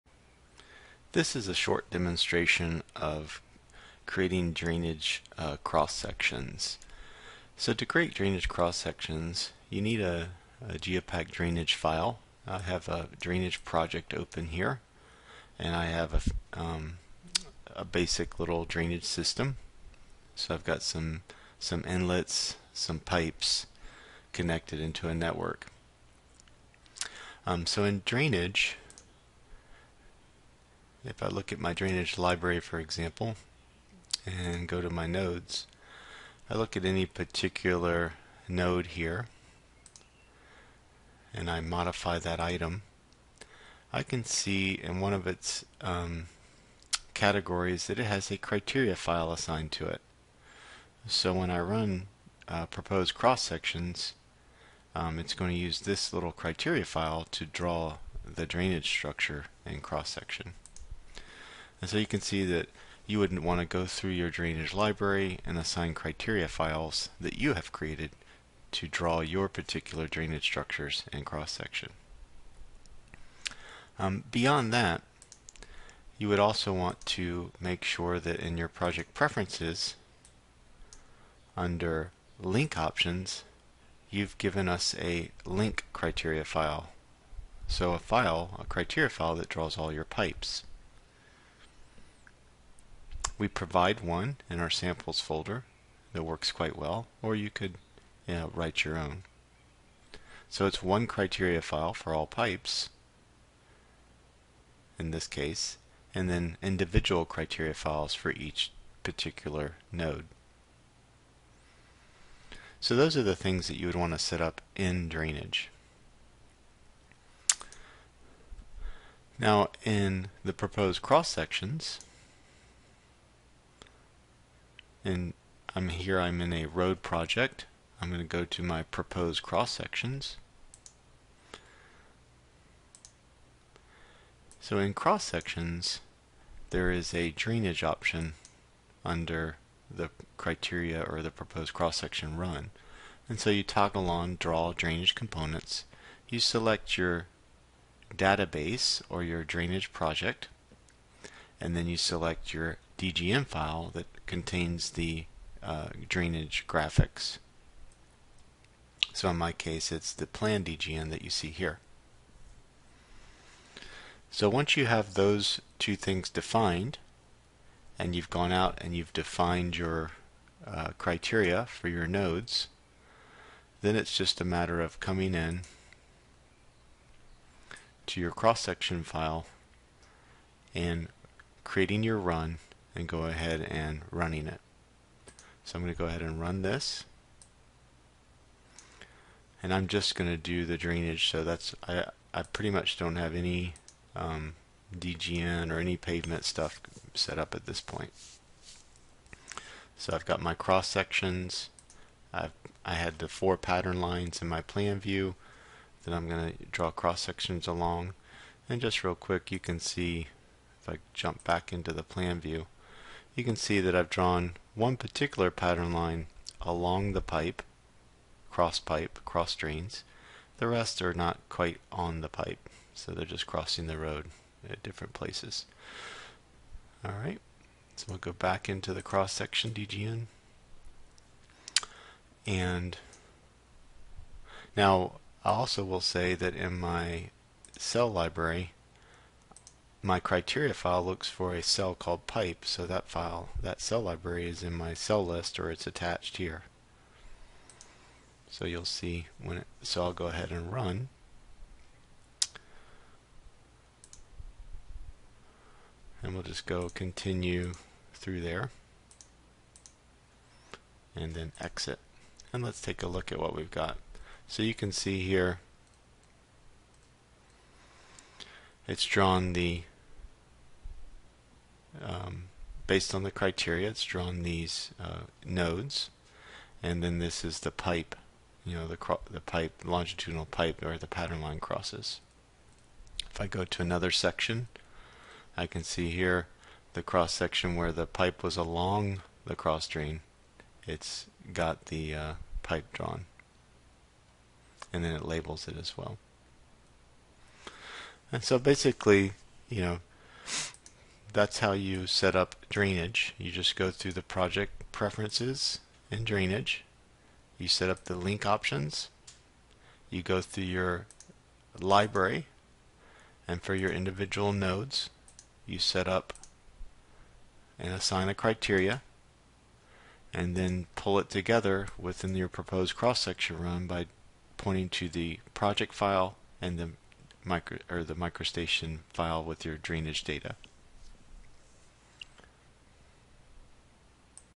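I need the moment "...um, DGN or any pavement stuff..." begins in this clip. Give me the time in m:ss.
3:14.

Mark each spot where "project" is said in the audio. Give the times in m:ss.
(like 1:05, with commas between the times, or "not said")
0:13, 1:18, 2:07, 2:29, 5:04, 5:25.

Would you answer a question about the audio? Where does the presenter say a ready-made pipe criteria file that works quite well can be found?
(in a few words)
samples folder.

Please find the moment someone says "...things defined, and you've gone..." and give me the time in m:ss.
2:45.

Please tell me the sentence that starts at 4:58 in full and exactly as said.
And so basically, you know, that's how you set up drainage.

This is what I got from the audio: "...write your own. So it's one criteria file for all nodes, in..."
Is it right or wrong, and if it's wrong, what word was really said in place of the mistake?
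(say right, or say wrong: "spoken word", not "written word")
wrong: "pipes", not "nodes".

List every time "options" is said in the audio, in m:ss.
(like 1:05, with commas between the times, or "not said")
1:22, 2:17, 5:08.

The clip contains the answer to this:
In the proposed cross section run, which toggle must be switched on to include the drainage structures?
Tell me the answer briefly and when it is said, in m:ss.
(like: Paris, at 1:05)
draw drainage components, at 2:24.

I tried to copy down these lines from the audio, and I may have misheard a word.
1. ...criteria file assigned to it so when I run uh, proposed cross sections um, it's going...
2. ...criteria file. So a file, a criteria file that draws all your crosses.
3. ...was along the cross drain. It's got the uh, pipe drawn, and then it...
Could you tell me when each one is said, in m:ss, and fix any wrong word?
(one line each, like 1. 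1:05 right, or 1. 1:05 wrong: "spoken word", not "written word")
1. 0:48 right
2. 1:25 wrong: "pipes", not "crosses"
3. 4:48 right.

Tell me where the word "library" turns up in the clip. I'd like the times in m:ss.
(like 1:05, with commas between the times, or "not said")
0:32, 1:04, 3:58, 4:04, 5:11.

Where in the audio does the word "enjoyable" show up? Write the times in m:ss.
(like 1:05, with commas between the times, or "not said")
not said.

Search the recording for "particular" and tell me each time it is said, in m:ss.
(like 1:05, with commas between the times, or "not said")
0:37, 1:09, 1:49, 3:34.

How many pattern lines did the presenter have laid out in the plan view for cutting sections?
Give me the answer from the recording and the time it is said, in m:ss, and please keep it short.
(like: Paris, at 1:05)
4, at 3:23.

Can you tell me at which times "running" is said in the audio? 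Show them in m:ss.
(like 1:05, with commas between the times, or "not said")
3:04.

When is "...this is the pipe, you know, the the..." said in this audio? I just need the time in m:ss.
4:37.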